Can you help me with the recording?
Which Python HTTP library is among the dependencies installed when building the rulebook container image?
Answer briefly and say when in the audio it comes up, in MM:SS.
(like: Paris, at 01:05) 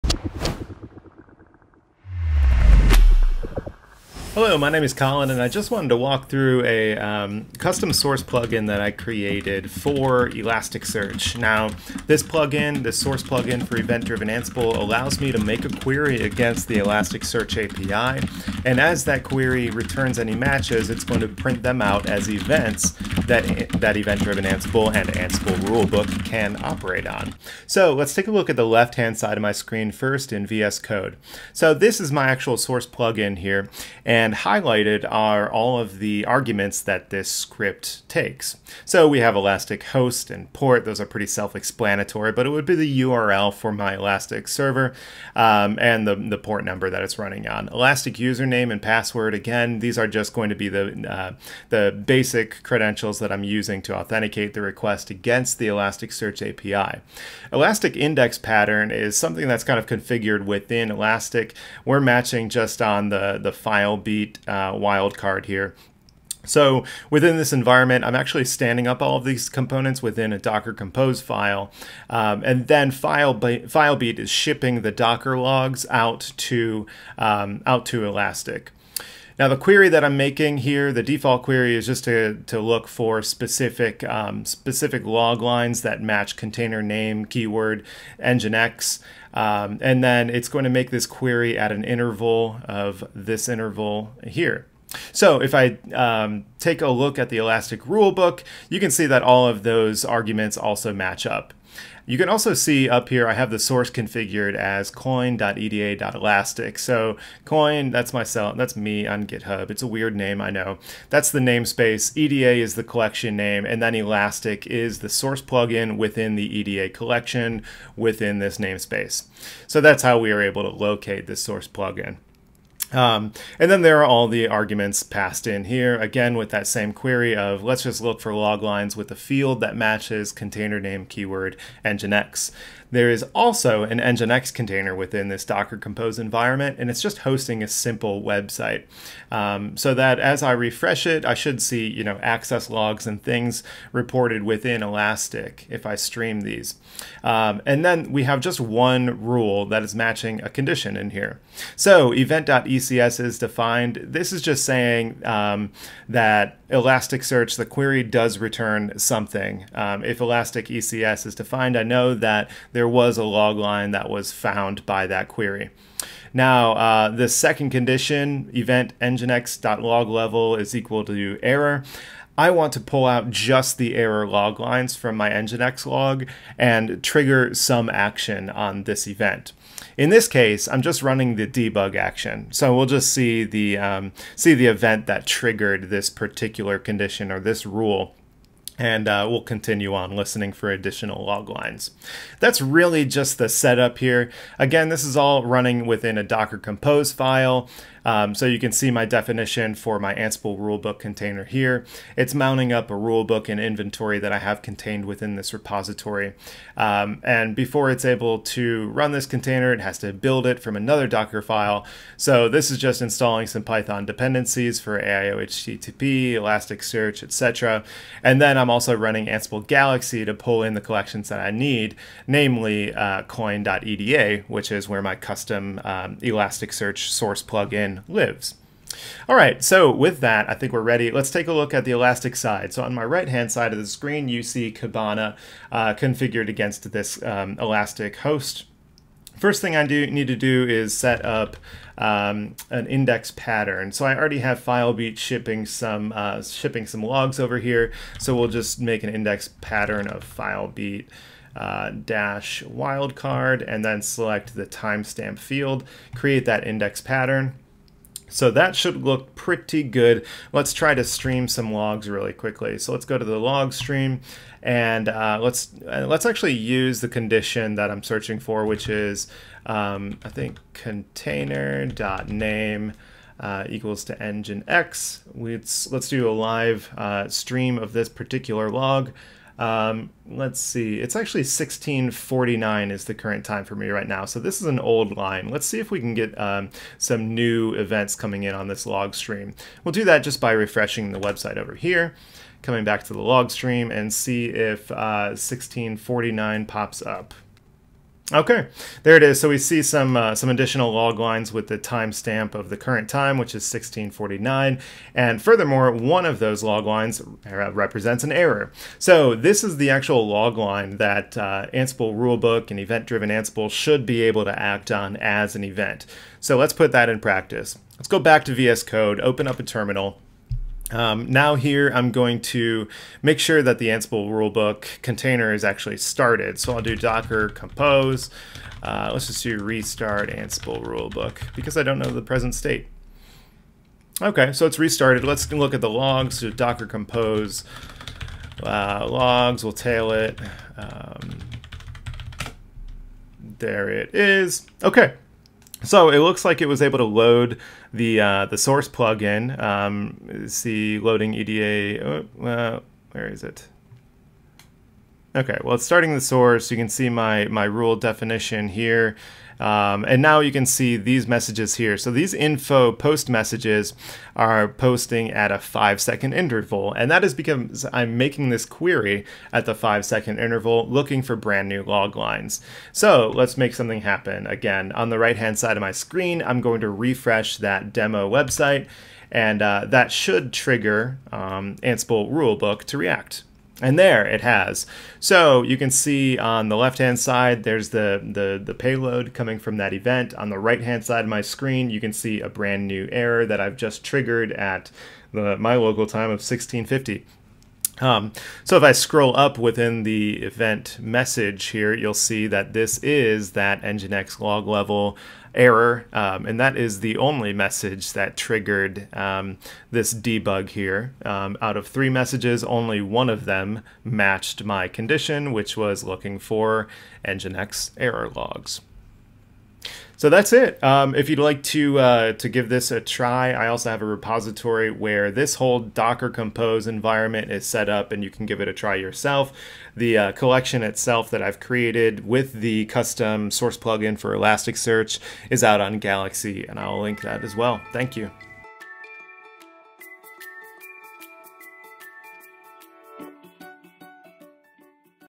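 AIO HTTP, at 03:34.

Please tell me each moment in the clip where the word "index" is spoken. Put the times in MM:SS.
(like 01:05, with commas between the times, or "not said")
00:57, 04:02, 04:09, 04:16.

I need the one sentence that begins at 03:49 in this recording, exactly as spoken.
All right, so with that, I think we're ready.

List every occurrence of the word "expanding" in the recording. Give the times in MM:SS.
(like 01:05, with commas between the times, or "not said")
not said.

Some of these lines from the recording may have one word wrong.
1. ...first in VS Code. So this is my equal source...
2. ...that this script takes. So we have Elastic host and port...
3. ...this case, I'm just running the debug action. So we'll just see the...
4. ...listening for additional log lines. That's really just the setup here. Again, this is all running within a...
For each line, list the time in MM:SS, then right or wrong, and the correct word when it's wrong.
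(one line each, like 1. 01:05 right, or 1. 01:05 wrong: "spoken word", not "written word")
1. 00:29 wrong: "actual", not "equal"
2. 00:36 right
3. 03:00 right
4. 03:10 right.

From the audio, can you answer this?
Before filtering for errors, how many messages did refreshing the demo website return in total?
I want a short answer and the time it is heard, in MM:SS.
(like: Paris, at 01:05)
3, at 06:51.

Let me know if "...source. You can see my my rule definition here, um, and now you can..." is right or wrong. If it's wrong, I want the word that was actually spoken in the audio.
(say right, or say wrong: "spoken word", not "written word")
right.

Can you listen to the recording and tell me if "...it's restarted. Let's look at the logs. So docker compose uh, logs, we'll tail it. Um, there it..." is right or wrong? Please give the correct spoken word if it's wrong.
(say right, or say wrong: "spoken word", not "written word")
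right.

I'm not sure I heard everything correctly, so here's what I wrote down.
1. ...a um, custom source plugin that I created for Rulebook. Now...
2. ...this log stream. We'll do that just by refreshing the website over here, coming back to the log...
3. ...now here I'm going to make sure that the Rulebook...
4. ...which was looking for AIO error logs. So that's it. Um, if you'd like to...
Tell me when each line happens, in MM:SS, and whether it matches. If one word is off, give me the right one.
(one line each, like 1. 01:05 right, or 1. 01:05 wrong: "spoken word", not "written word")
1. 00:06 wrong: "Elasticsearch", not "Rulebook"
2. 04:48 right
3. 05:21 wrong: "Ansible", not "Rulebook"
4. 06:55 wrong: "Nginx", not "AIO".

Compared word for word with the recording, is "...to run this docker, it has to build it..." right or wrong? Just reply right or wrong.
wrong.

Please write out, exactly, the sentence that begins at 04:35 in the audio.
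Let's, let's do a live uh, stream of this particular log.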